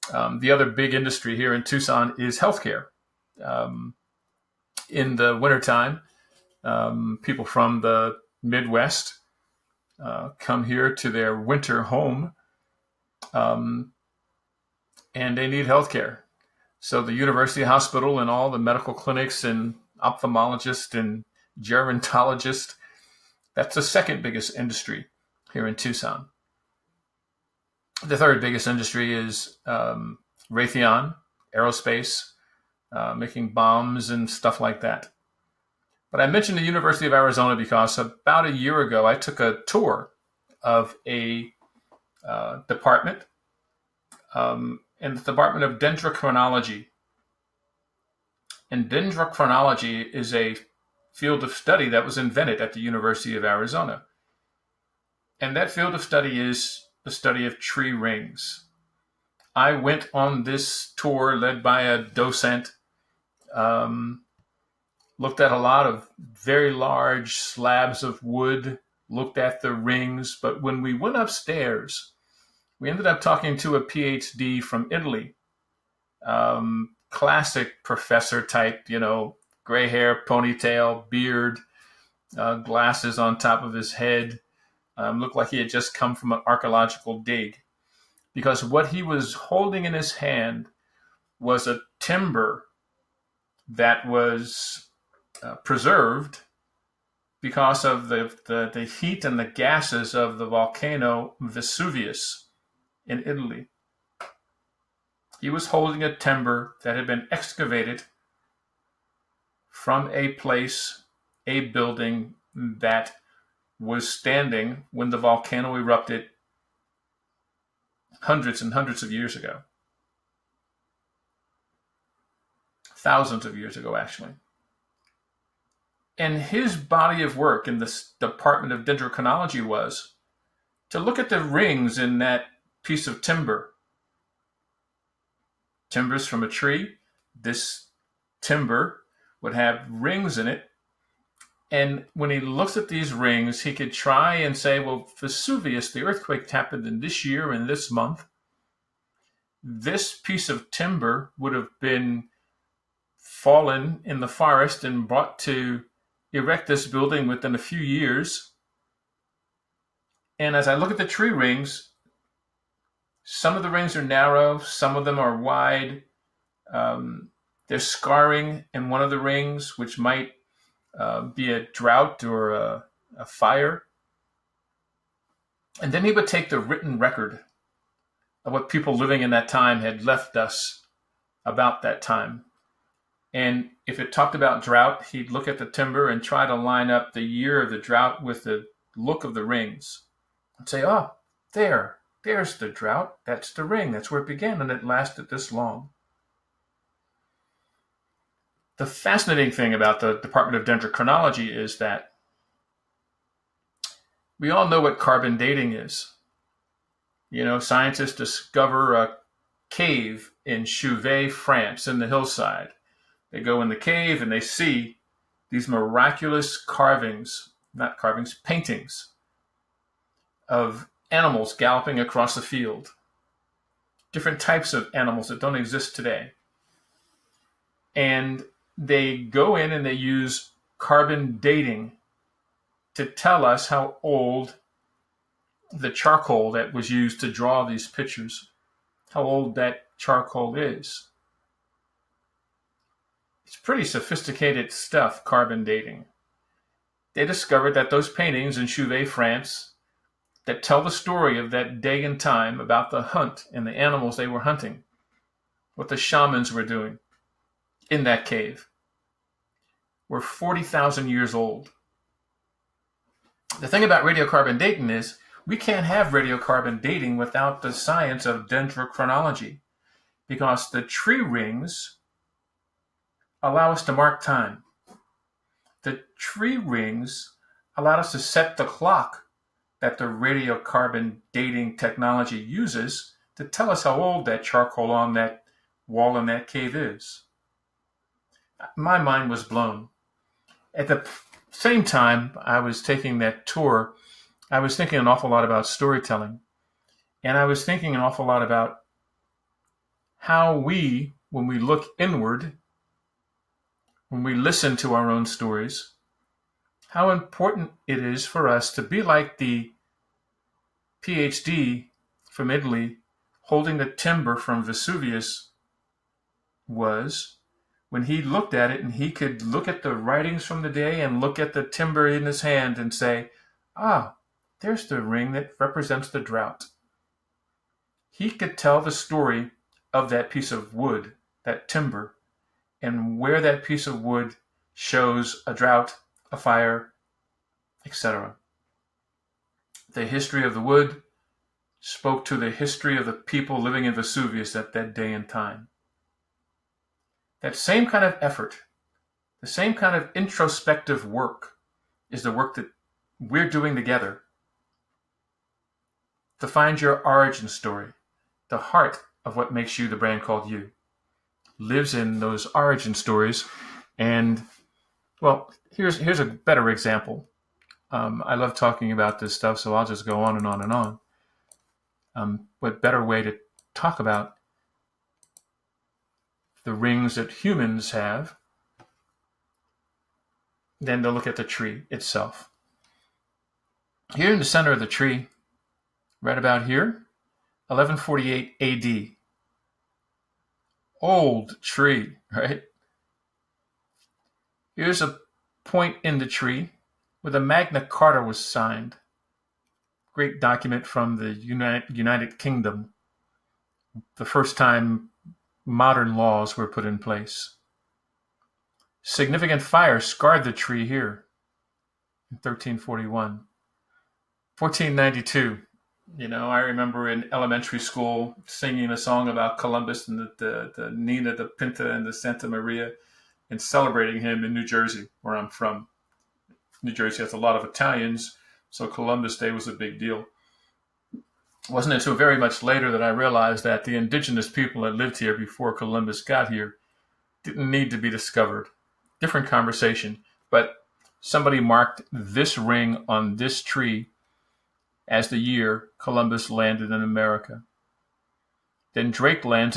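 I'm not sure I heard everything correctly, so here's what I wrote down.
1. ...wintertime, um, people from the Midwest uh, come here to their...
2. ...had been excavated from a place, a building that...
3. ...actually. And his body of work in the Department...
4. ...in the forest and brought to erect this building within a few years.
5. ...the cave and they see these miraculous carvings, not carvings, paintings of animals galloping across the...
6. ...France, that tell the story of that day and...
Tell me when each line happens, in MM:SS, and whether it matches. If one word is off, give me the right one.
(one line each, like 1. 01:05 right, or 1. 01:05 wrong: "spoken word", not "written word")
1. 00:05 right
2. 01:46 right
3. 02:03 right
4. 02:34 right
5. 03:33 right
6. 04:09 right.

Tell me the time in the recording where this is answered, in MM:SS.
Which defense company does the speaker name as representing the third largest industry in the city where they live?
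00:30.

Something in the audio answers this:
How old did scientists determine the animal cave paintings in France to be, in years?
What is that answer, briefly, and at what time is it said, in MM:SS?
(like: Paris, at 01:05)
40,000, at 04:20.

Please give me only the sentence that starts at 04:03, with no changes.
It's pretty sophisticated stuff, carbon dating.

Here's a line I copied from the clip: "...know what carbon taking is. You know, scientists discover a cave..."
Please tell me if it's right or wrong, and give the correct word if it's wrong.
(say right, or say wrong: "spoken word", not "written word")
wrong: "dating", not "taking".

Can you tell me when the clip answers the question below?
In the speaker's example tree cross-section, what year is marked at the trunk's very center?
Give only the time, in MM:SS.
06:27.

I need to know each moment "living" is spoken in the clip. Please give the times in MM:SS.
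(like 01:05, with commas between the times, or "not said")
02:58, 05:43.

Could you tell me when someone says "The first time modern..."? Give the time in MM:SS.
06:44.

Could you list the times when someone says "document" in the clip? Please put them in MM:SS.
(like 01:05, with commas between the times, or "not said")
06:40.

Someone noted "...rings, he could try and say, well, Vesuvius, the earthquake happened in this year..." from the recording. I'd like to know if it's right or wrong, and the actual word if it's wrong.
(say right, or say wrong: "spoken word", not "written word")
right.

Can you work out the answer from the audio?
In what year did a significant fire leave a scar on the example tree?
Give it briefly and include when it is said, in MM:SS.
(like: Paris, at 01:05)
1341, at 06:52.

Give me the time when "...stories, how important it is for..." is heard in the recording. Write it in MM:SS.
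05:05.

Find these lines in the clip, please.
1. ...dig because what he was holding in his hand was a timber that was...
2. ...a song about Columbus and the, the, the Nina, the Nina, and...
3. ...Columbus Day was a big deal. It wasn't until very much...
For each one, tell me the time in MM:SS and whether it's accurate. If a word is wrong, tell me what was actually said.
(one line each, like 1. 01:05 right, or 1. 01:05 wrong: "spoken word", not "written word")
1. 01:27 right
2. 06:58 wrong: "Pinta", not "Nina"
3. 07:08 right.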